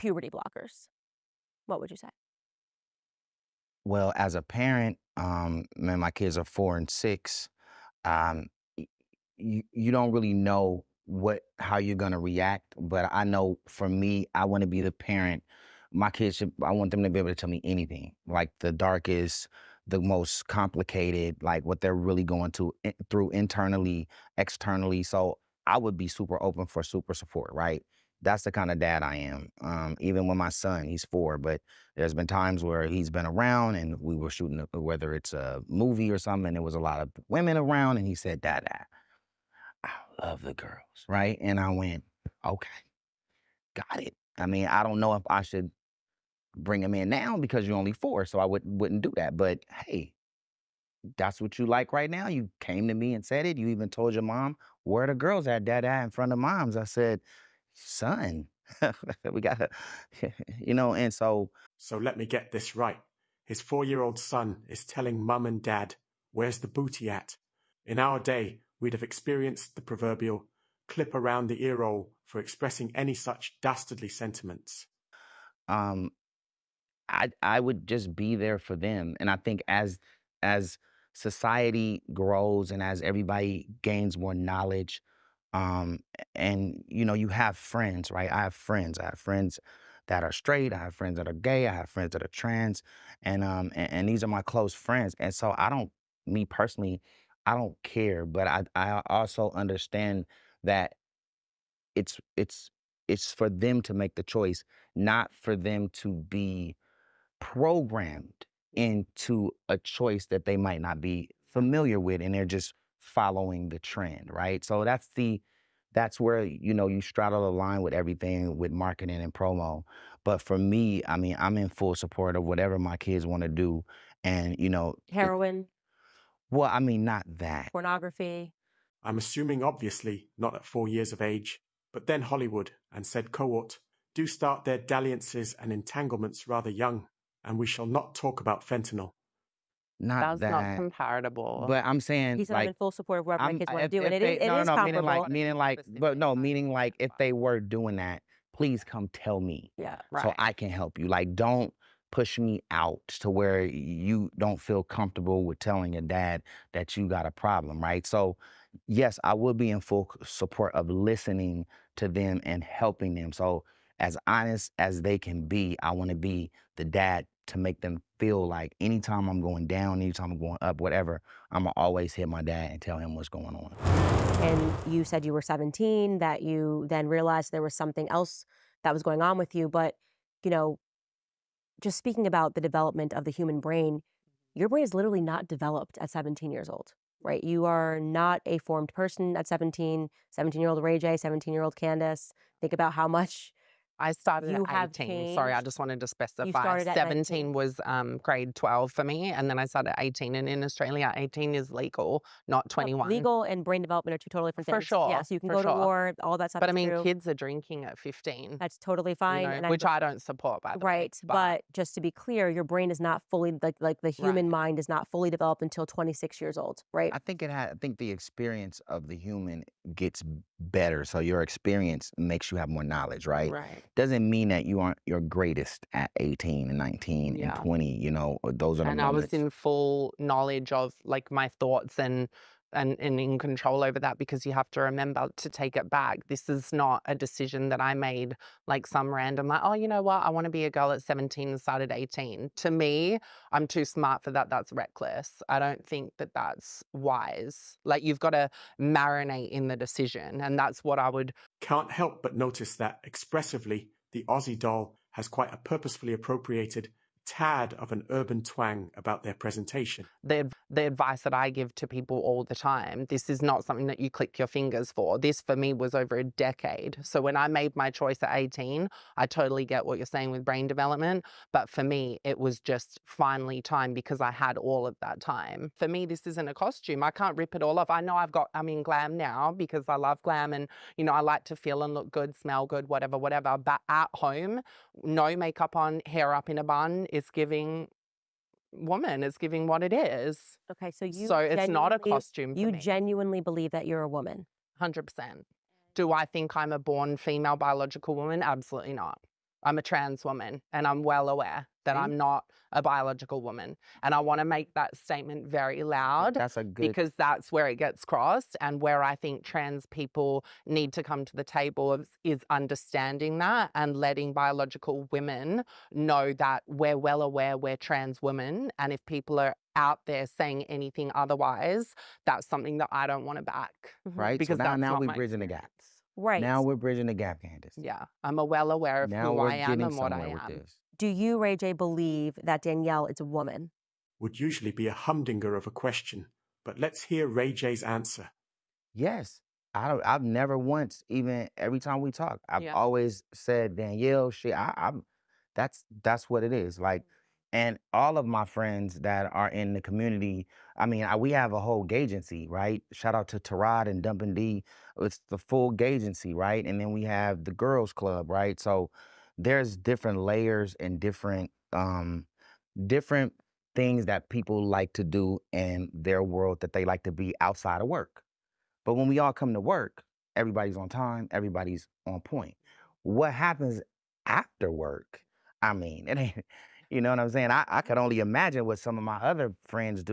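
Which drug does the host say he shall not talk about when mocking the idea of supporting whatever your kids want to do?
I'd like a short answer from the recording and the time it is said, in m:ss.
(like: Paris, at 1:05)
Fentanyl, at 2:18.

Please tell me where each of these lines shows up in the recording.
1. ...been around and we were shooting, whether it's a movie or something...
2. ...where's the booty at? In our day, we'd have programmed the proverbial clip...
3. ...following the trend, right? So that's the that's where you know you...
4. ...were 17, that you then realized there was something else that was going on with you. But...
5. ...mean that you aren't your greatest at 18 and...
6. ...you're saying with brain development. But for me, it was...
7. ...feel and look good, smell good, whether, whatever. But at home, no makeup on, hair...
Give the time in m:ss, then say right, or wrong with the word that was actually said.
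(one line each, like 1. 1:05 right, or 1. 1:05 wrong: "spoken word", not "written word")
1. 0:33 right
2. 1:06 wrong: "experienced", not "programmed"
3. 1:53 right
4. 2:55 right
5. 3:44 right
6. 4:29 right
7. 4:41 wrong: "whatever", not "whether".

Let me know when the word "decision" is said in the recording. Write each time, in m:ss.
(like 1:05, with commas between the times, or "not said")
3:57, 4:09.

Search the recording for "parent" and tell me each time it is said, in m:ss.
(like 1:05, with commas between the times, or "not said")
0:04, 0:14.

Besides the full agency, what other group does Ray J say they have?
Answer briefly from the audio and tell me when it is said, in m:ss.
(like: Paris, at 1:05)
The girls club, at 5:57.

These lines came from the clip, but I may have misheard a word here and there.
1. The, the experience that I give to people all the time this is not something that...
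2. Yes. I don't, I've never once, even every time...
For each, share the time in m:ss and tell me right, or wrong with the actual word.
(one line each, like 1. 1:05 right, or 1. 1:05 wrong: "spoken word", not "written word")
1. 4:20 wrong: "advice", not "experience"
2. 5:38 right.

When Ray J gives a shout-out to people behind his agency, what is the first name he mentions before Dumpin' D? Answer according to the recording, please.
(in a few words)
Tarad.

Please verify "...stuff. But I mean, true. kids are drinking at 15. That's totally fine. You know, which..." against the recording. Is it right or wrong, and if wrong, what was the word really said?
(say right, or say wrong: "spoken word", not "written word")
right.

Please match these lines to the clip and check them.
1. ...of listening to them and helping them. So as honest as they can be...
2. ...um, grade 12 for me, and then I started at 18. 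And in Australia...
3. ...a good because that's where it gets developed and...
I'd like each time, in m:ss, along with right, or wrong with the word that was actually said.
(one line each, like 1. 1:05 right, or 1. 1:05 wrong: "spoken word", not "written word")
1. 2:40 right
2. 3:17 right
3. 5:06 wrong: "crossed", not "developed".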